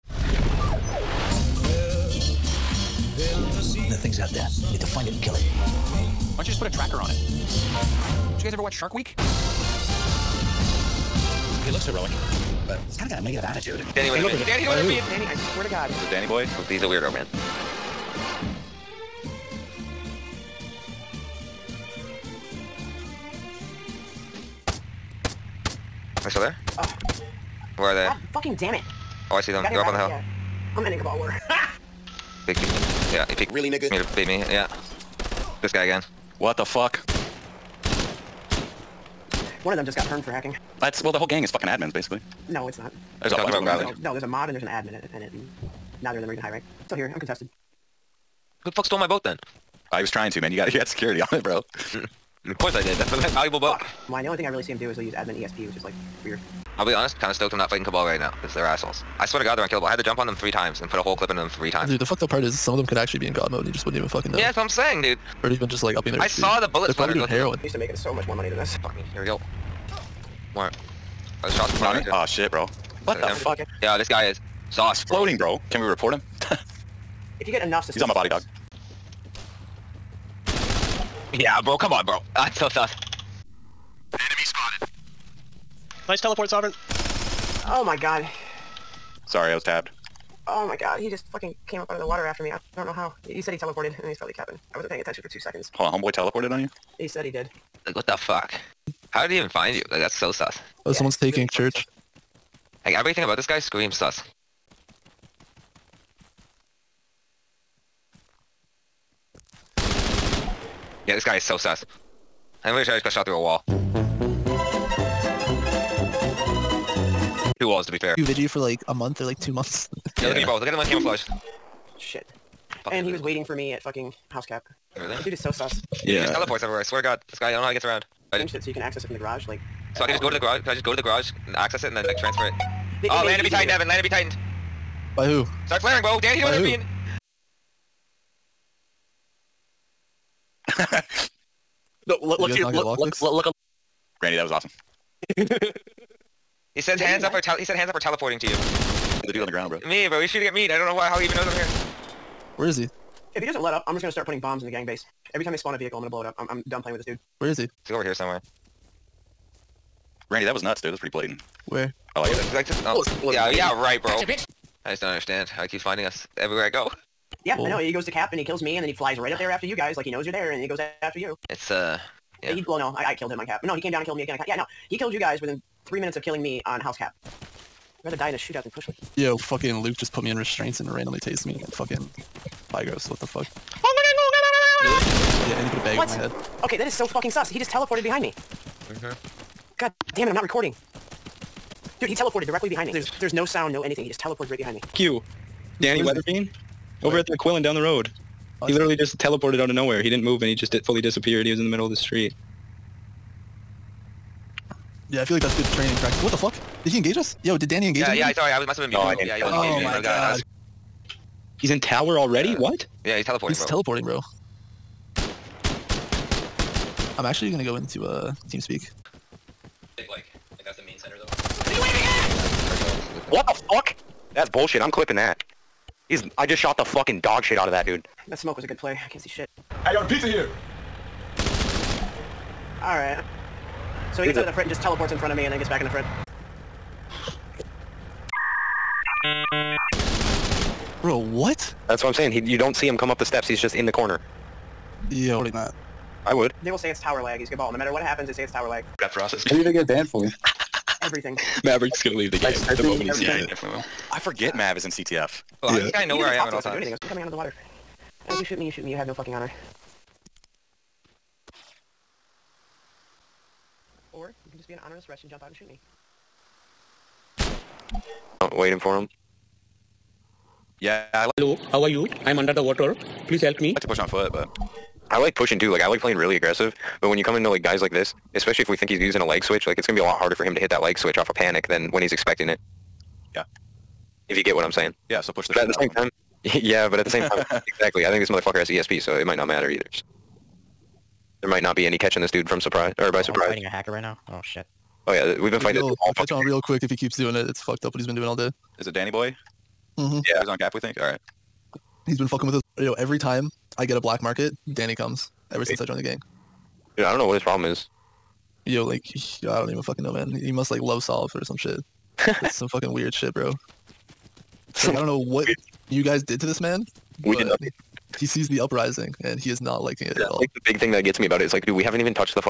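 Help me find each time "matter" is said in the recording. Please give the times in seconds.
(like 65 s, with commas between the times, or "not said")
247 s, 289 s.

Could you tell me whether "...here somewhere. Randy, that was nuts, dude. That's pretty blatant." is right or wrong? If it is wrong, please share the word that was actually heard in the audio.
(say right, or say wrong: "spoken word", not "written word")
right.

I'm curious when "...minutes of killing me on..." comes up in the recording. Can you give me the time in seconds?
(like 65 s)
175 s.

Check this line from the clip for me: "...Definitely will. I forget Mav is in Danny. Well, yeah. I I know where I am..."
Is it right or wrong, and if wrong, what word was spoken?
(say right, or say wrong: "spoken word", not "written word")
wrong: "CTF", not "Danny".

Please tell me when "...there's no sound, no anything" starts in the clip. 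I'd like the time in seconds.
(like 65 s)
193 s.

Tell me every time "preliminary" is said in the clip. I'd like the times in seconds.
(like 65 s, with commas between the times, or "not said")
not said.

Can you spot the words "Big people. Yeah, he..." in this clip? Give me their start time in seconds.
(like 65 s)
32 s.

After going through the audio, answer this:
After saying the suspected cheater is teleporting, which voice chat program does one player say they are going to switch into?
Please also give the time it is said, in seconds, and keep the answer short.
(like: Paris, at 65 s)
TeamSpeak, at 218 s.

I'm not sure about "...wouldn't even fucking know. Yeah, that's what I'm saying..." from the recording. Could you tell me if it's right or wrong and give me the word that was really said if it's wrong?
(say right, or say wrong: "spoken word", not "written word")
right.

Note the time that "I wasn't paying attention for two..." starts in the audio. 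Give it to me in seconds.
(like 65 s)
94 s.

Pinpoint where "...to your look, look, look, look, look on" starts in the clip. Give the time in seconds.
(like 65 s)
142 s.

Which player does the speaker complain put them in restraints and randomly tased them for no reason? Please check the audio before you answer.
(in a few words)
Luke.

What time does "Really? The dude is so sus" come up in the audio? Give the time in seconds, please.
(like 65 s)
124 s.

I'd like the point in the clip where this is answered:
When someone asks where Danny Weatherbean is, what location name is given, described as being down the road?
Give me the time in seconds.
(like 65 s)
197 s.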